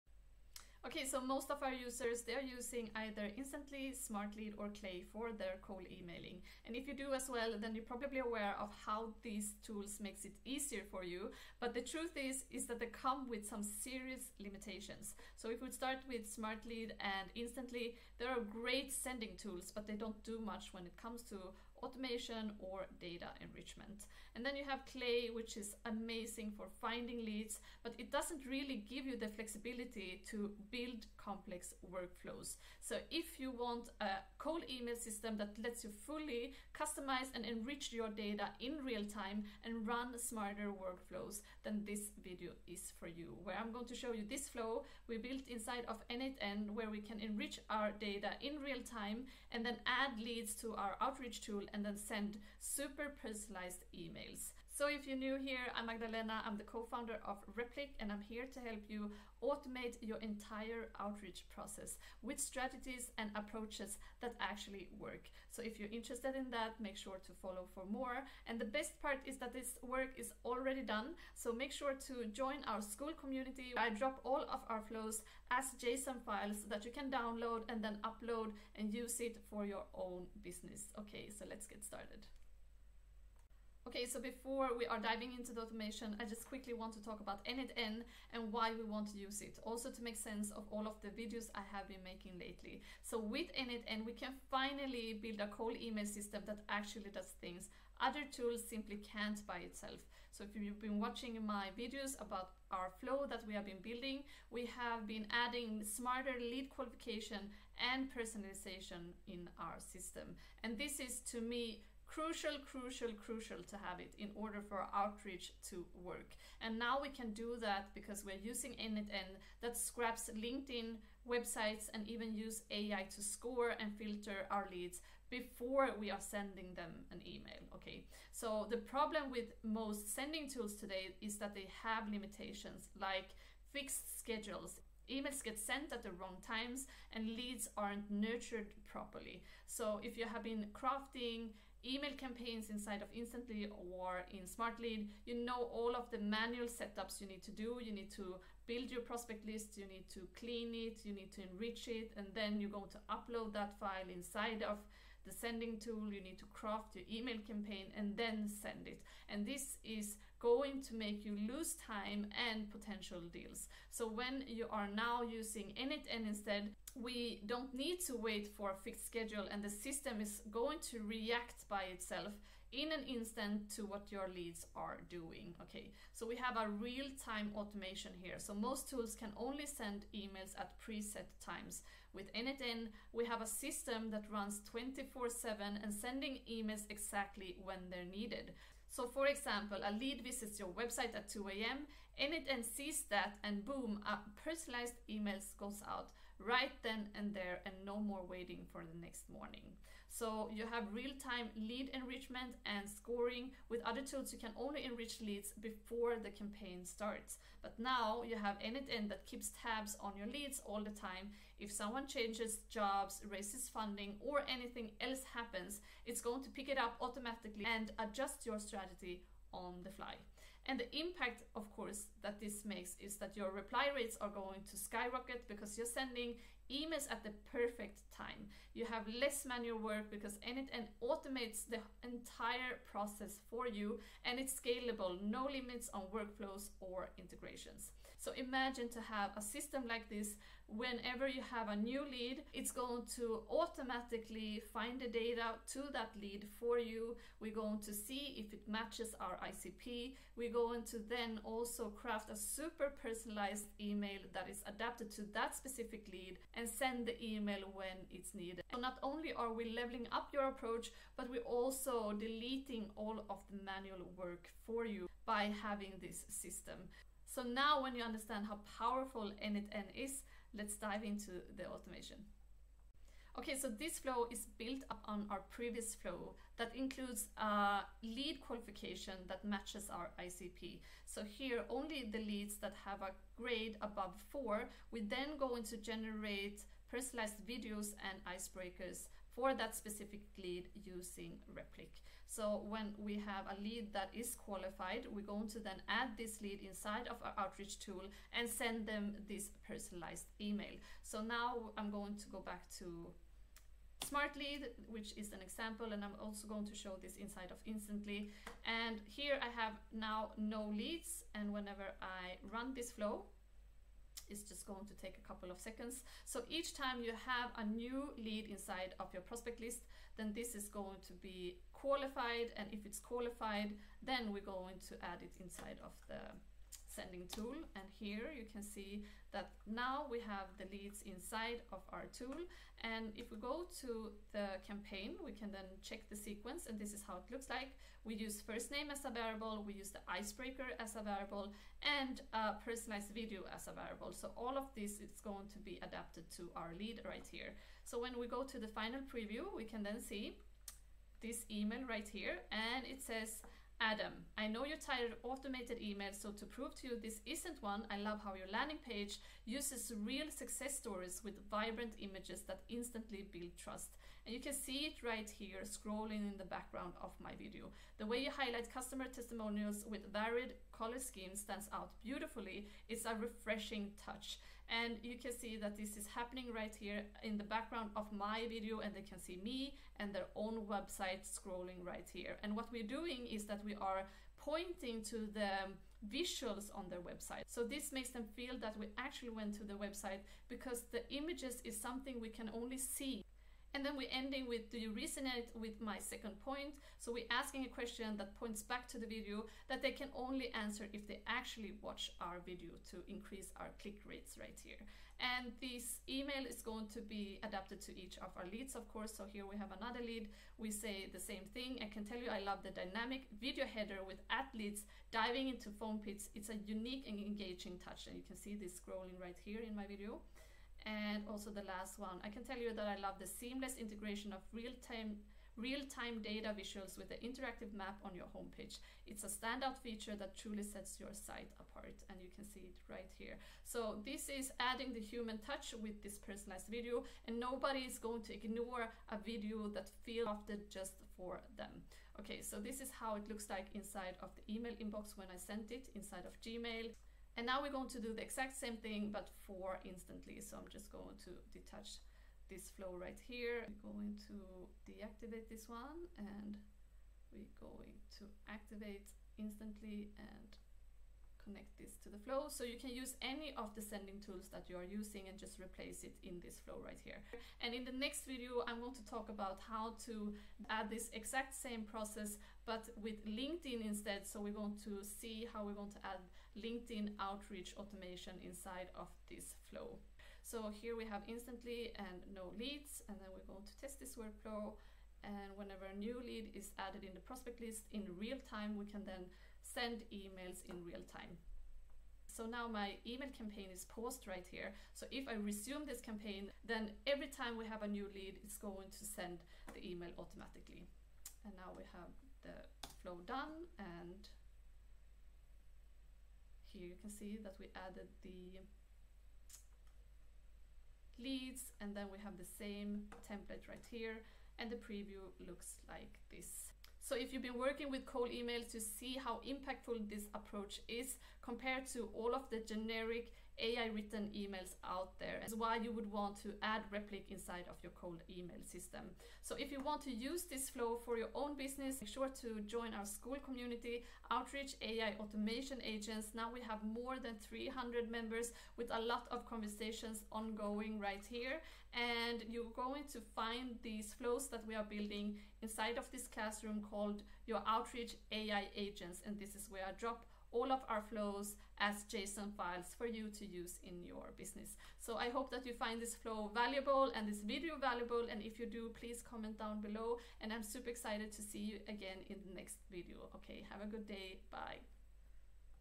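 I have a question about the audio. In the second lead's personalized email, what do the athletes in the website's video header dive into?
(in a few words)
foam pits.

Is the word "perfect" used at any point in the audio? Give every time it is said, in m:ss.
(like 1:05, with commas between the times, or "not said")
3:47.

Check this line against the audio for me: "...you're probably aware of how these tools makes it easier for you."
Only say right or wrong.
right.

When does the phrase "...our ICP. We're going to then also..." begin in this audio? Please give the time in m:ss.
4:09.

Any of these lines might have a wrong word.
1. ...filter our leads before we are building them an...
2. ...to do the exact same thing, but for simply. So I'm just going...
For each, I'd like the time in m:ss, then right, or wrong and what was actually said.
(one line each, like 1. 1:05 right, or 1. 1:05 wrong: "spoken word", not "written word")
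1. 2:03 wrong: "sending", not "building"
2. 7:27 wrong: "instantly", not "simply".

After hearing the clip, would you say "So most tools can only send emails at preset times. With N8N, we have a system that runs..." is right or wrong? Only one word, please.
right.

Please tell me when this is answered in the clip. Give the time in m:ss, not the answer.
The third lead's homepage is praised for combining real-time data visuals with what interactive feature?
7:07.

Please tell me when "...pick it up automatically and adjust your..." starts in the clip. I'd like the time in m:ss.
3:36.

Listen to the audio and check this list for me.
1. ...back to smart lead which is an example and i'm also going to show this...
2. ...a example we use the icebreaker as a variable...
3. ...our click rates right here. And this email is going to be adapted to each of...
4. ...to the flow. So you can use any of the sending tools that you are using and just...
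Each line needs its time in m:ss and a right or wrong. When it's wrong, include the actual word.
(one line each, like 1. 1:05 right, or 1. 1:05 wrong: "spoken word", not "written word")
1. 5:02 right
2. 5:39 wrong: "variable", not "example"
3. 6:43 right
4. 7:42 right.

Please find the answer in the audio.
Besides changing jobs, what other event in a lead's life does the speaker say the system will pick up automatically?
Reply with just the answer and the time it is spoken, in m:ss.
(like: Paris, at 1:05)
raises funding, at 3:33.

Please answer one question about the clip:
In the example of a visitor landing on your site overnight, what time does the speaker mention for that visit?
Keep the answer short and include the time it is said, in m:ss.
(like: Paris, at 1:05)
2 a.m., at 3:11.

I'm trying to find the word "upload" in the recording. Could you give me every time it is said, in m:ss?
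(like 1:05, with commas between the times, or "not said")
1:18, 2:33.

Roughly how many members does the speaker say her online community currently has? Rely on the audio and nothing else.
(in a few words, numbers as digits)
300.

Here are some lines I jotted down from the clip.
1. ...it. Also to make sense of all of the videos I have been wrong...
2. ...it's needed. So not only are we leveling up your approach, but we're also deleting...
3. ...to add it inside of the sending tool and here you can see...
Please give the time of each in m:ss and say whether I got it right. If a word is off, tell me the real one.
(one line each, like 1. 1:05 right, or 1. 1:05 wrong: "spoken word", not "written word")
1. 1:29 wrong: "making", not "wrong"
2. 4:18 right
3. 5:24 right.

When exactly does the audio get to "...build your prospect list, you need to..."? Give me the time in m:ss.
2:28.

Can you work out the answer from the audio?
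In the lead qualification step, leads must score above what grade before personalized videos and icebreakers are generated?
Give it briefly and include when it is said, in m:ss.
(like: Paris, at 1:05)
4, at 4:44.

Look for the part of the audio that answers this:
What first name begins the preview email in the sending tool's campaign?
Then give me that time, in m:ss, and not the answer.
5:53.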